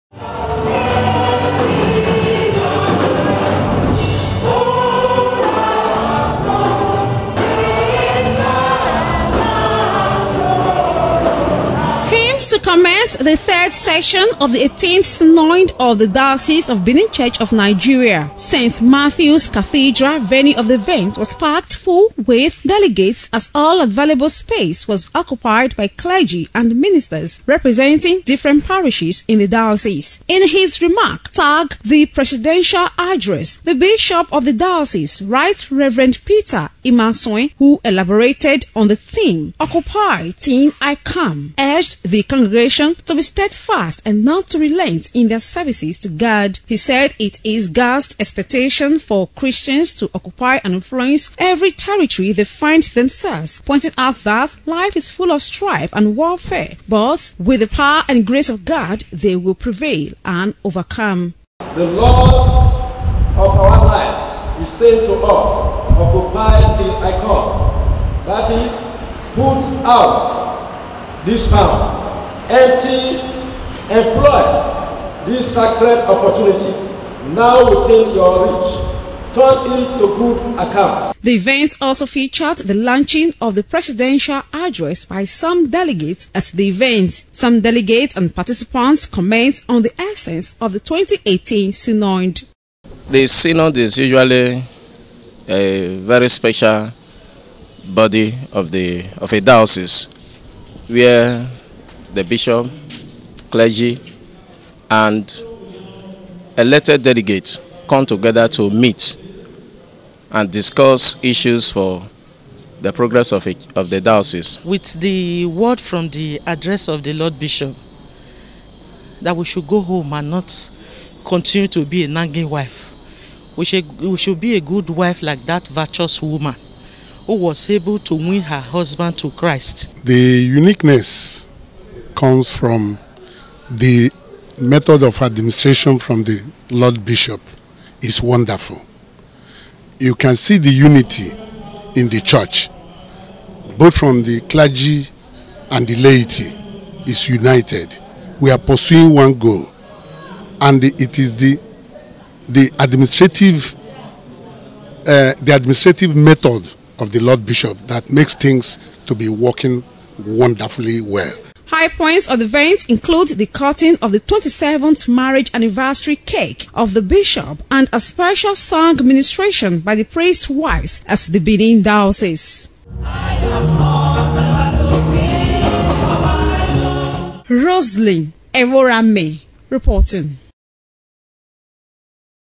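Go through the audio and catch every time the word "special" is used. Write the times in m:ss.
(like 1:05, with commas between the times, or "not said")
1:36, 2:47.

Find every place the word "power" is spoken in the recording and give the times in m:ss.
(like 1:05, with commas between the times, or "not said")
0:57, 1:11.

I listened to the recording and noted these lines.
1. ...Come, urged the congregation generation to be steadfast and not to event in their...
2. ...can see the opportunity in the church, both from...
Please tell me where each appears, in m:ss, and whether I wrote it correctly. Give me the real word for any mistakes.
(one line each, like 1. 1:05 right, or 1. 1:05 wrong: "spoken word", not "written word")
1. 0:40 wrong: "relent", not "event"
2. 2:20 wrong: "unity", not "opportunity".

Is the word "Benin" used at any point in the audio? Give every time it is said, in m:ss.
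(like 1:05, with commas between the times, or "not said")
0:16, 2:51.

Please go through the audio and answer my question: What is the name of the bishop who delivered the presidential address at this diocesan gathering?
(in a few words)
Peter Imasuen.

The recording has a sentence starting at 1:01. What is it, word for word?
The Lord of our life is saying to us, Occupy till I come.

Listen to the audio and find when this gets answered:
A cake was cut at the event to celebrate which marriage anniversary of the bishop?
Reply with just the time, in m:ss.
2:44.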